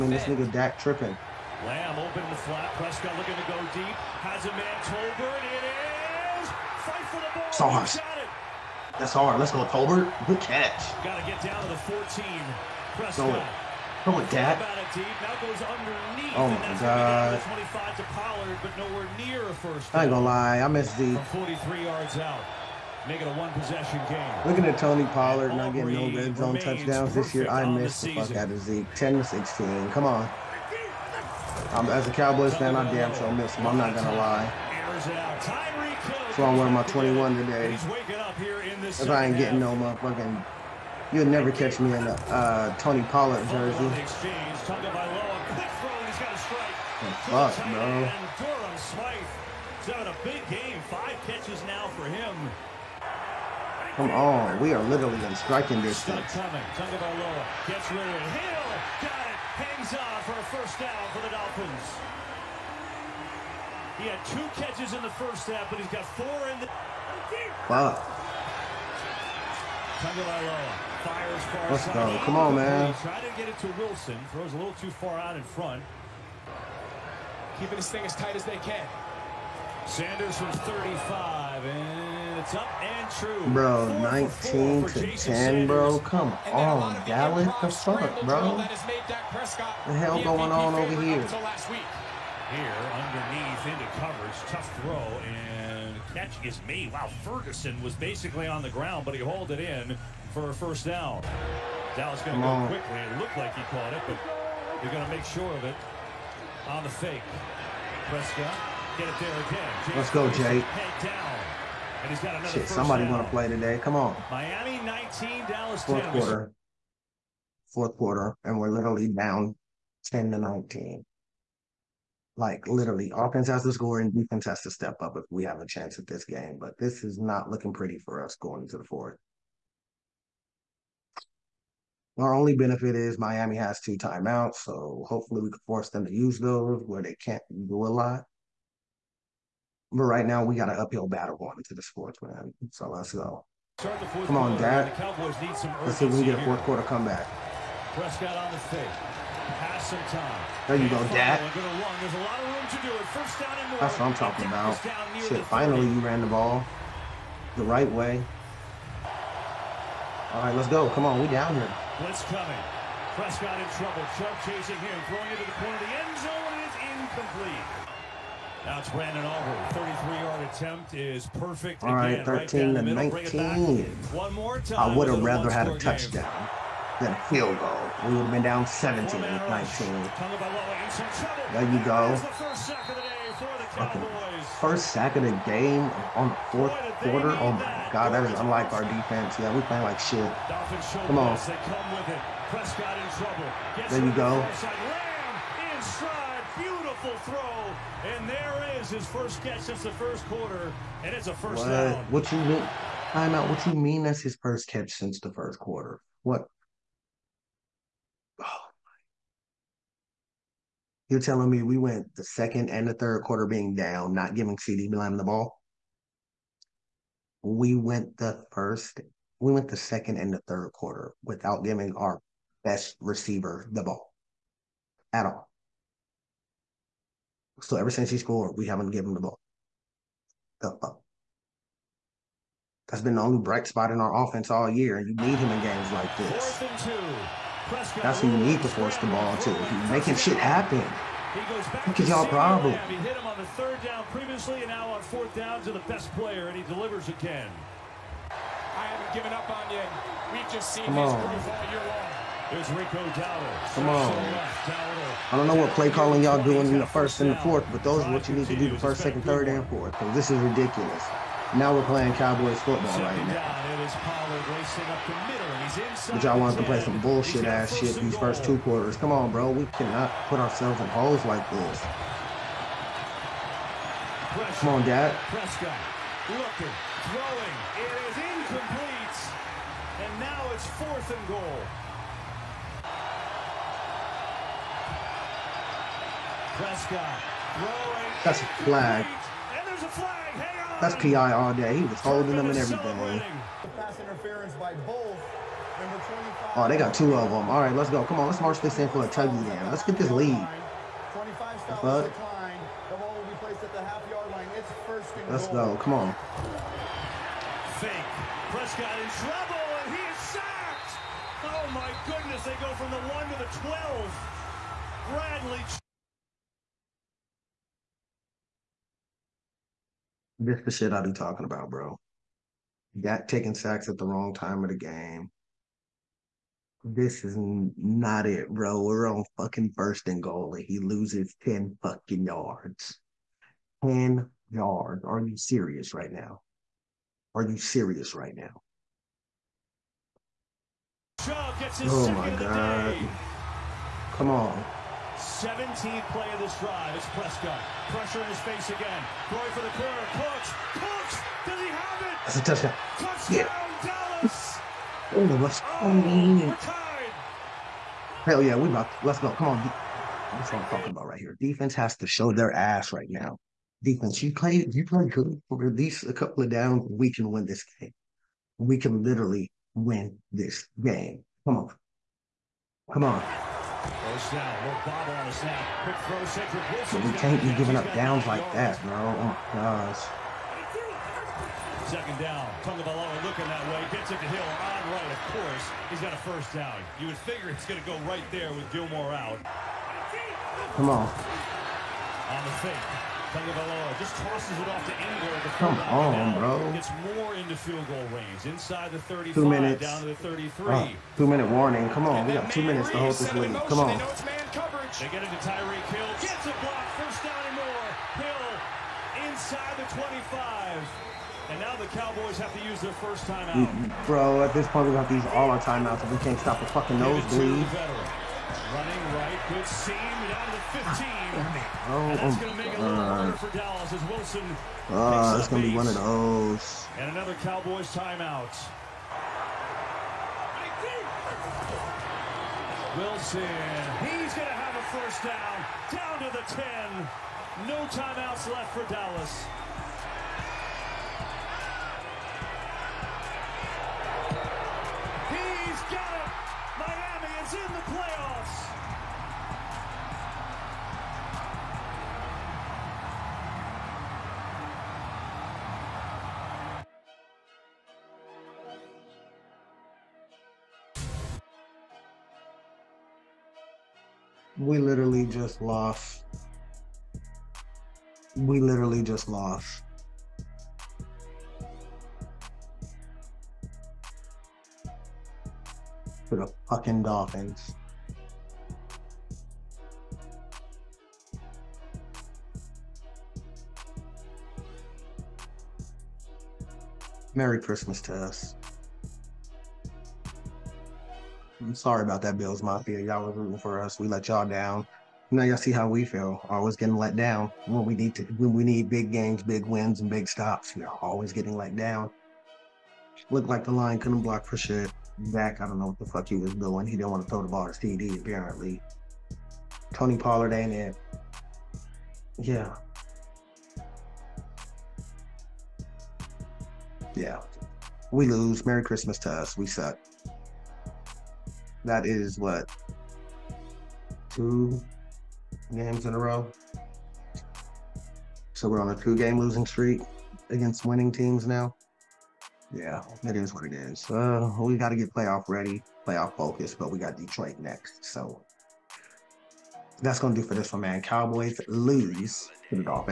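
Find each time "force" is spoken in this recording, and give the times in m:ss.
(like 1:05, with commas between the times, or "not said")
2:15, 3:58.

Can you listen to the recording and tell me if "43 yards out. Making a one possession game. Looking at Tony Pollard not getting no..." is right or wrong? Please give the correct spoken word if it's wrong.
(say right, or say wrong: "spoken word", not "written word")
right.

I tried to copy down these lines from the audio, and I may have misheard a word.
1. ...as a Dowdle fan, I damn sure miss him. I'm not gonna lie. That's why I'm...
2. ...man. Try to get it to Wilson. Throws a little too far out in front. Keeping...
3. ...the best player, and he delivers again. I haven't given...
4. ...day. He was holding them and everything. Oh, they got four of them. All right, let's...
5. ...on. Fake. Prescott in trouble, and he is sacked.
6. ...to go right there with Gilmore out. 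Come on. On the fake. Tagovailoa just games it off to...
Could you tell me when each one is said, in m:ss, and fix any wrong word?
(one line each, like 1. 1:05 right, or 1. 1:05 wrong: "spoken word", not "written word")
1. 0:31 wrong: "Cowboys", not "Dowdle"
2. 1:12 right
3. 4:05 right
4. 4:51 wrong: "two", not "four"
5. 5:05 right
6. 6:27 wrong: "tosses", not "games".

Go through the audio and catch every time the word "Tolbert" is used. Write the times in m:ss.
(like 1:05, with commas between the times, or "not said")
0:04, 0:09.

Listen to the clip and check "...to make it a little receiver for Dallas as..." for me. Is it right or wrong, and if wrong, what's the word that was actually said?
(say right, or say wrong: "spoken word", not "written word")
wrong: "harder", not "receiver".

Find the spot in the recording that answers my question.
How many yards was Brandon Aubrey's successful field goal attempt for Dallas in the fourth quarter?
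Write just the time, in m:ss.
2:49.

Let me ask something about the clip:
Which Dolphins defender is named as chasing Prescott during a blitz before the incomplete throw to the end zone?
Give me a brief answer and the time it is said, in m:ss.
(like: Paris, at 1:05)
Chubb, at 2:44.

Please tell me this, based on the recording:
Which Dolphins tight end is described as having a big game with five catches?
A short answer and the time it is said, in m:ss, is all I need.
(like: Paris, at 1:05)
Durham Smythe, at 0:48.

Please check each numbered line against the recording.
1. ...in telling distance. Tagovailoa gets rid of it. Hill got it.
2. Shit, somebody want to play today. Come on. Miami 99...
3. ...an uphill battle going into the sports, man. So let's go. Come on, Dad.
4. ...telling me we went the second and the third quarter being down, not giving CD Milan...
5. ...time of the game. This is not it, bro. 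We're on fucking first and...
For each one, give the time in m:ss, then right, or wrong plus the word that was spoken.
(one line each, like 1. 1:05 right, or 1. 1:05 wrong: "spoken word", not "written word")
1. 0:55 wrong: "striking", not "telling"
2. 1:52 wrong: "19", not "99"
3. 2:20 right
4. 3:31 right
5. 5:24 right.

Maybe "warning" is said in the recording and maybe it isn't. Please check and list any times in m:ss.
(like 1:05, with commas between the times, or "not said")
6:41.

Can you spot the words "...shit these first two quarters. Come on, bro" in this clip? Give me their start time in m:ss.
4:27.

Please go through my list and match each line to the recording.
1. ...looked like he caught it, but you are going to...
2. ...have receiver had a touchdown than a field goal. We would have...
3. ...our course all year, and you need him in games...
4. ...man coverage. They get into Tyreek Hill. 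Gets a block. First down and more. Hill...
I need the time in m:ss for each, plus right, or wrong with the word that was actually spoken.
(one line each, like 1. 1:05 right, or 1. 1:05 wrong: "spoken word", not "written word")
1. 1:43 right
2. 2:55 wrong: "rather", not "receiver"
3. 3:53 wrong: "offense", not "course"
4. 6:44 right.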